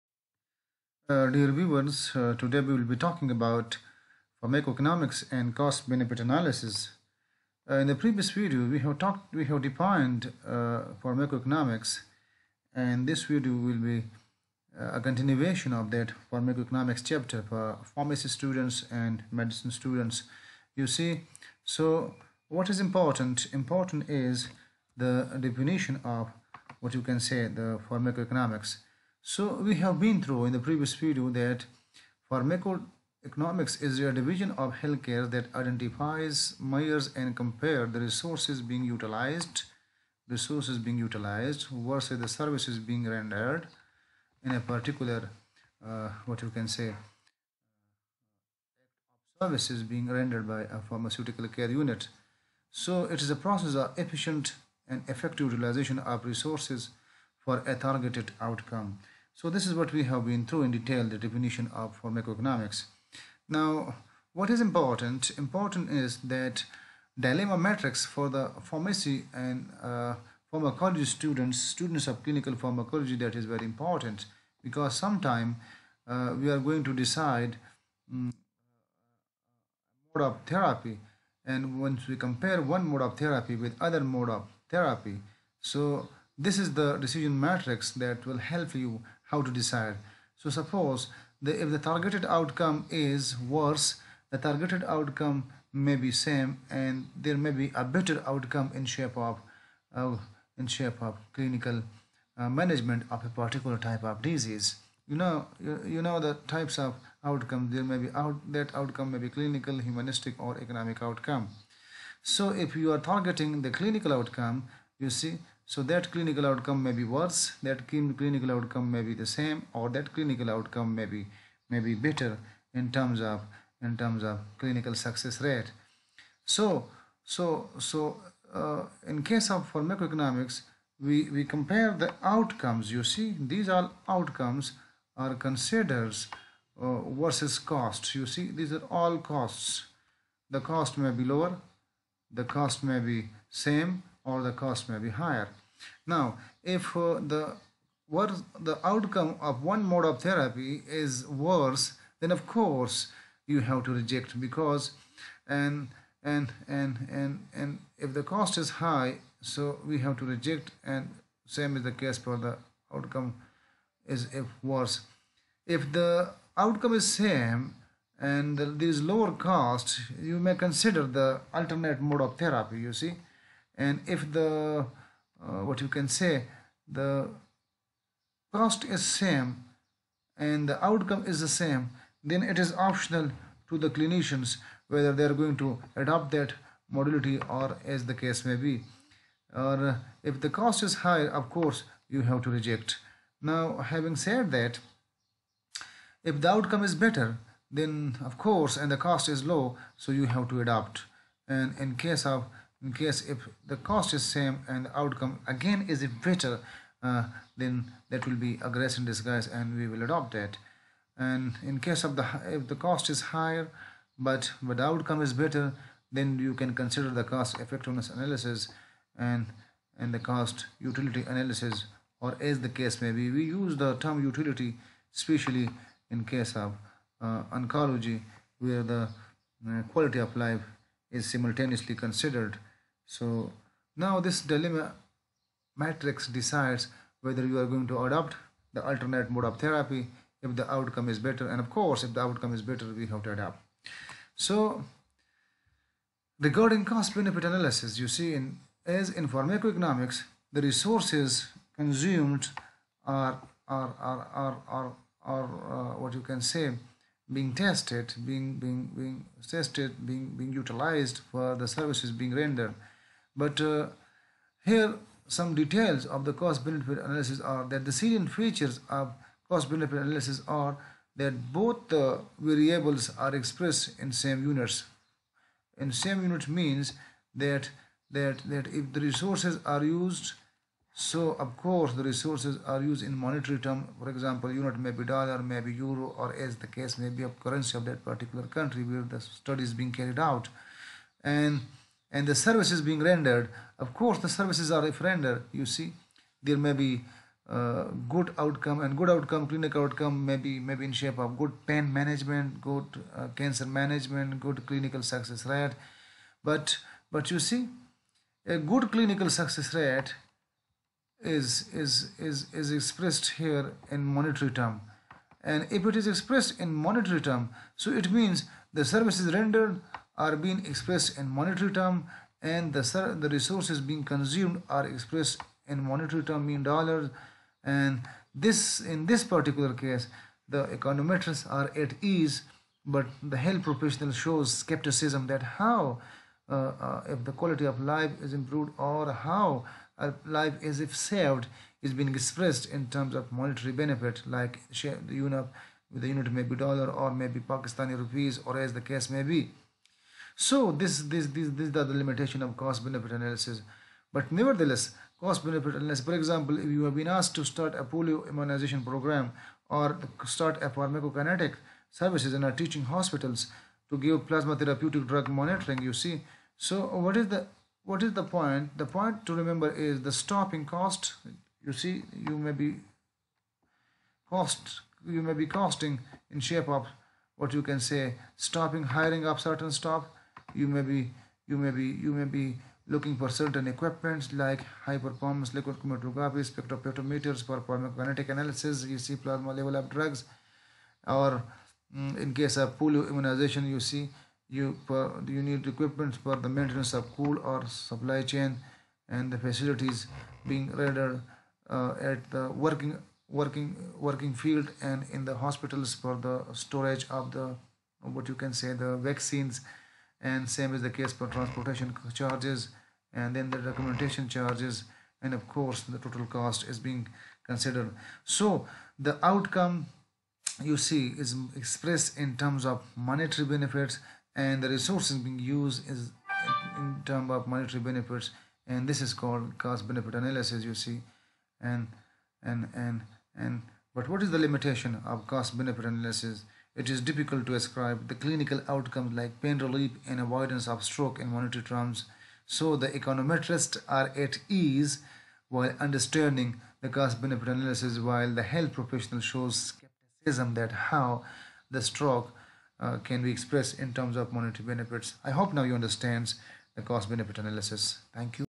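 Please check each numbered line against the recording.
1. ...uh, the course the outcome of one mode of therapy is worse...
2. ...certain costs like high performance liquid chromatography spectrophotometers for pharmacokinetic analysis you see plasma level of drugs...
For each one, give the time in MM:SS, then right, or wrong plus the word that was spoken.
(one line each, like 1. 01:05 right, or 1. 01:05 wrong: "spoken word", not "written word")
1. 02:26 wrong: "worse", not "course"
2. 06:23 wrong: "equipments", not "costs".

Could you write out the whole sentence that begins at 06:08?
The point to remember is the stopping cost.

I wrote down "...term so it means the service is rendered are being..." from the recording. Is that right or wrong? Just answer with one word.
right.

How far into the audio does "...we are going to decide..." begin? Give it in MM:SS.
01:16.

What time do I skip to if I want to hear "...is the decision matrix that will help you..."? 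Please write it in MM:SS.
01:26.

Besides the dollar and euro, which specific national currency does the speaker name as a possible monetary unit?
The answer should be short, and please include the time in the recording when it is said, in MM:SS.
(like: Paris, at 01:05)
Pakistani rupees, at 05:47.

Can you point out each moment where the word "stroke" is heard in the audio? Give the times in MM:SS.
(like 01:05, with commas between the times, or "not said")
07:20, 07:31.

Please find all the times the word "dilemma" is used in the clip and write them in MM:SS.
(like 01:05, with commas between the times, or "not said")
01:07, 03:54.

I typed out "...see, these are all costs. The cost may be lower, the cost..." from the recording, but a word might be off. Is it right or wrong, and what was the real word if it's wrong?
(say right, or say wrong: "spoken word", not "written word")
right.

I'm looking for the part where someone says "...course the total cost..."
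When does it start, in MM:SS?
06:55.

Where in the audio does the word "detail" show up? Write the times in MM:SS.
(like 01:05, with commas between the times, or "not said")
01:00, 04:25.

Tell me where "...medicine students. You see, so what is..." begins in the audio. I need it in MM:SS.
00:19.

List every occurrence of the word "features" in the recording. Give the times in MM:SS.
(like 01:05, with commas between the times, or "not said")
04:28.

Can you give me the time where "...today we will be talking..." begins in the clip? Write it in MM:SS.
00:02.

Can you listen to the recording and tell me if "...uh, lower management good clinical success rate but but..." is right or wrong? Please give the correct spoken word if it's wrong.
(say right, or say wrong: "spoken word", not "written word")
wrong: "cancer", not "lower".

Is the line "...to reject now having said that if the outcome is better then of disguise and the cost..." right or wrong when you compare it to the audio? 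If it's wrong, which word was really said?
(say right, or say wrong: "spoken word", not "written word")
wrong: "course", not "disguise".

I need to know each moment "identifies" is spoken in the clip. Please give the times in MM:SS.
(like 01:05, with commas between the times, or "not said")
00:35.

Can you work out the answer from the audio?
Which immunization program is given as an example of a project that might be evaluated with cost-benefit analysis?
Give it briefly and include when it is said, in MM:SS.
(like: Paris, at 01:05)
polio immunization program, at 05:57.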